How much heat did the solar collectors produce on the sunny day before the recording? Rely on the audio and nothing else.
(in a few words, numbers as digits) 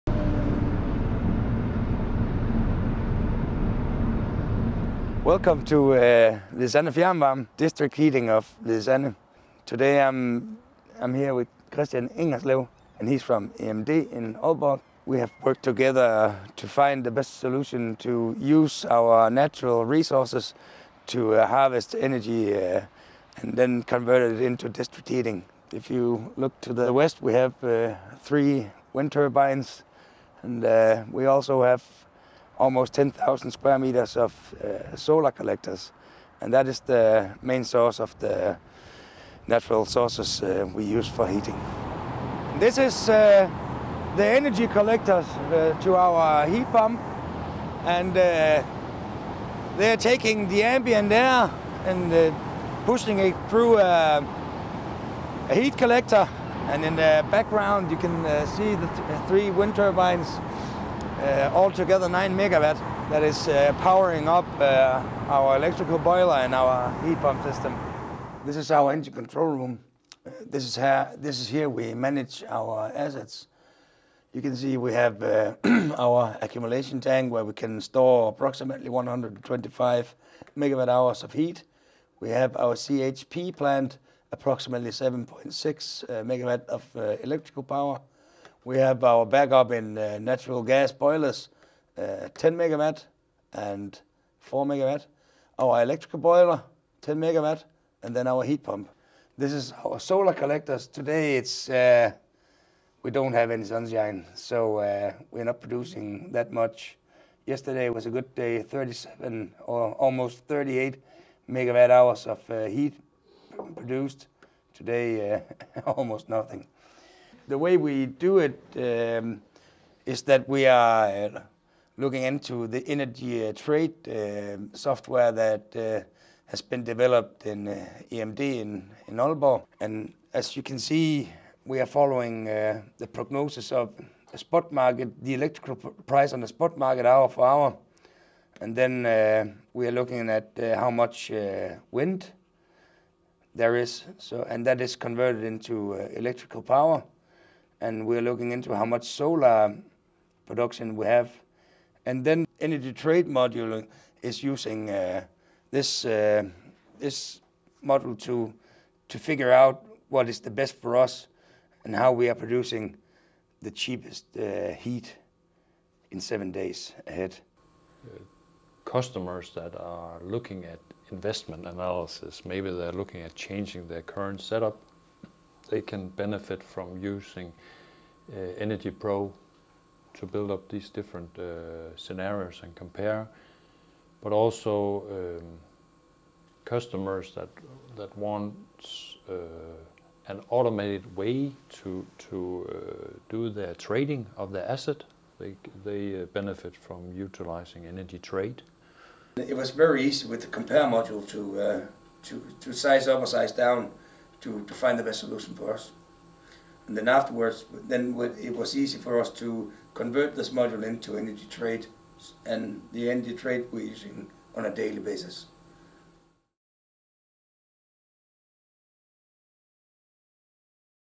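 almost 38 megawatt hours.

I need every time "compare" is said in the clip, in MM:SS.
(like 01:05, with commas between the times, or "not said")
03:02, 03:20.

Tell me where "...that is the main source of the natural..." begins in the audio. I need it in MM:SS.
00:36.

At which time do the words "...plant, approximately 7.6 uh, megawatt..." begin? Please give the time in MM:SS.
01:23.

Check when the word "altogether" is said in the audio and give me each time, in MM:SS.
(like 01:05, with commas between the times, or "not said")
01:01.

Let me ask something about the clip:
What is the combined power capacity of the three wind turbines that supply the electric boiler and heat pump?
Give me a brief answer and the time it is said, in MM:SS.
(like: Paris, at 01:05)
9 megawatt, at 01:02.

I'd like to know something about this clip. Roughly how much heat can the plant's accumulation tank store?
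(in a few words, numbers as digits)
125 megawatt hours.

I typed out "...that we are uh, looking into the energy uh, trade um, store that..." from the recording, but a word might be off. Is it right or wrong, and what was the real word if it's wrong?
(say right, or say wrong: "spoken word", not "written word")
wrong: "software", not "store".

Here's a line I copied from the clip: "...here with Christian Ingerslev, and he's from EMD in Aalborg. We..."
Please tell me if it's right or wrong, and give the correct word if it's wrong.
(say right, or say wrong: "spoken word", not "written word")
right.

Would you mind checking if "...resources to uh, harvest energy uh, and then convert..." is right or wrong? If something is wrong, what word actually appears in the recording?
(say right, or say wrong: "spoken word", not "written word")
right.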